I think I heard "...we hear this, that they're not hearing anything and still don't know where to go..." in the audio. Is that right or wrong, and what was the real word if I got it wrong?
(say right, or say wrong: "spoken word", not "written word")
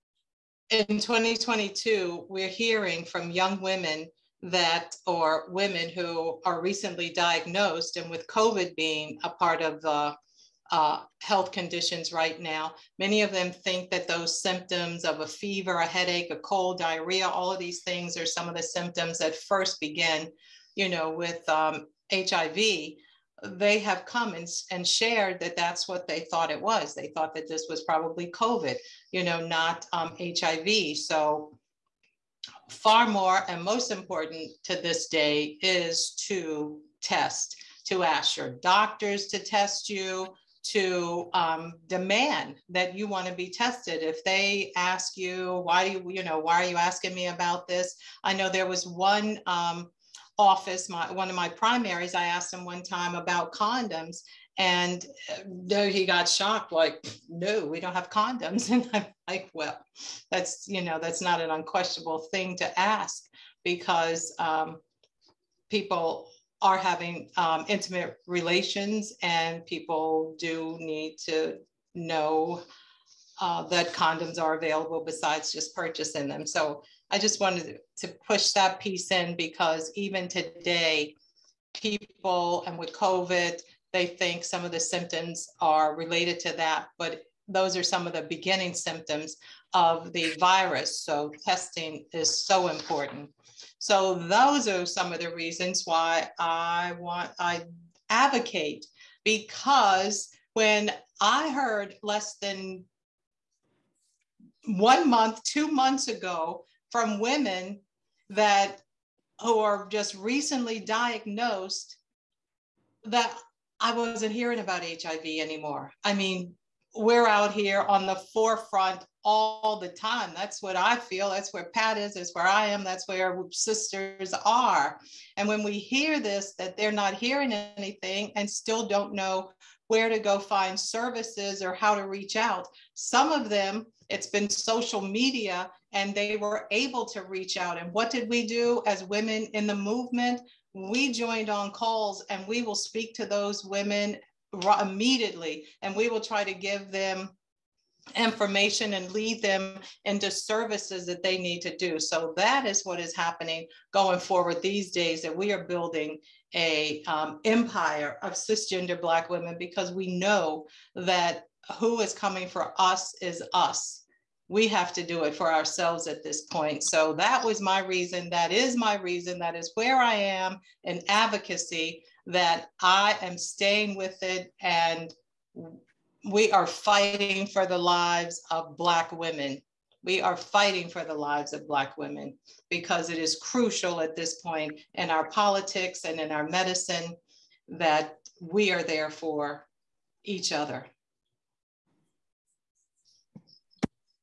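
right.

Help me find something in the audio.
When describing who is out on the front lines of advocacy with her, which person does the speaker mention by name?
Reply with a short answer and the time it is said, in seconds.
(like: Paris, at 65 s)
Pat, at 121 s.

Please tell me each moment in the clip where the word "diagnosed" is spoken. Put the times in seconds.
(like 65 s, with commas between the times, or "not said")
7 s, 110 s.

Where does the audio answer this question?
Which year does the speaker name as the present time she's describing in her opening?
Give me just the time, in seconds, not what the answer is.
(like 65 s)
0 s.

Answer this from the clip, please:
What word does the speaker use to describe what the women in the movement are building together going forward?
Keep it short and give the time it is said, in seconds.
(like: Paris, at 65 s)
Empire, at 157 s.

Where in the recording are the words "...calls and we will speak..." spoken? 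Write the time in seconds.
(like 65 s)
141 s.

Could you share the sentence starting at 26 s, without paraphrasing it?
They thought that this was probably COVID, you know, not um, HIV.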